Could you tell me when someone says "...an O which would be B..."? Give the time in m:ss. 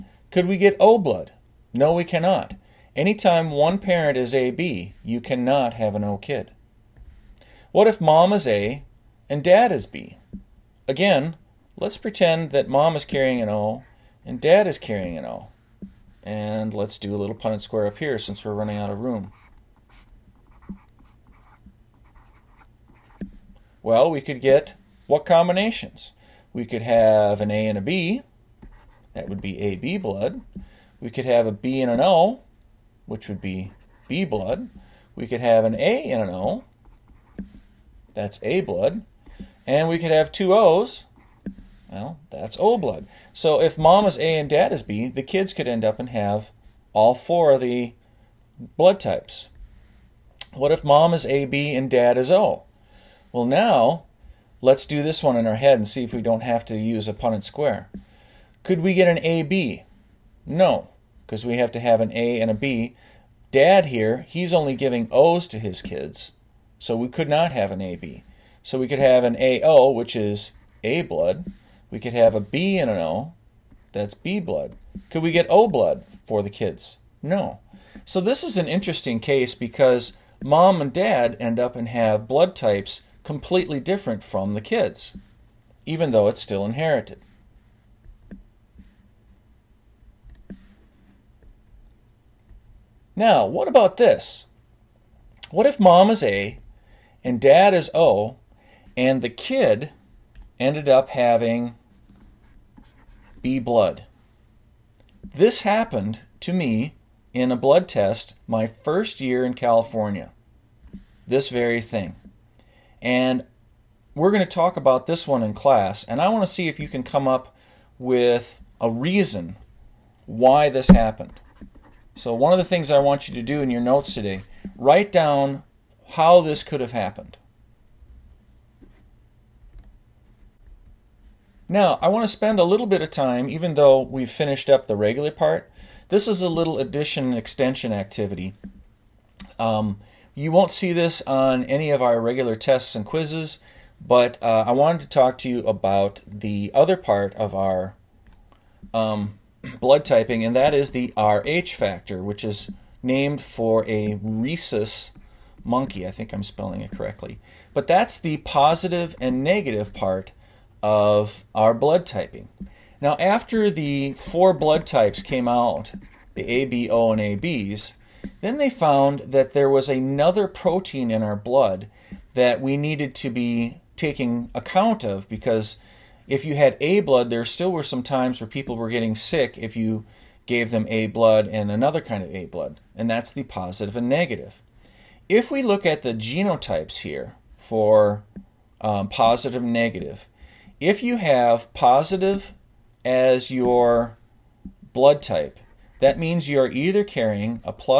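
0:31.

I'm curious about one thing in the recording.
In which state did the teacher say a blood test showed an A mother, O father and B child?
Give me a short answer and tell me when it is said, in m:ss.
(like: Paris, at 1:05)
California, at 1:49.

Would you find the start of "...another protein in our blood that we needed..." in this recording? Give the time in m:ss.
2:49.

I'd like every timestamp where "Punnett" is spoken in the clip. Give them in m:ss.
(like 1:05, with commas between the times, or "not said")
0:17, 0:57.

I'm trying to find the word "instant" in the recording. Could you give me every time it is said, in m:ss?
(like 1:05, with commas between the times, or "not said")
not said.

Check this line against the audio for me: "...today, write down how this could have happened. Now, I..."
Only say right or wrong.
right.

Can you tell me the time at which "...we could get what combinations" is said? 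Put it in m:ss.
0:24.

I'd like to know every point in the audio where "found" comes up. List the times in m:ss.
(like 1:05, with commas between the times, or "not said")
2:48.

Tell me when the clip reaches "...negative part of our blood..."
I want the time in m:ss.
2:39.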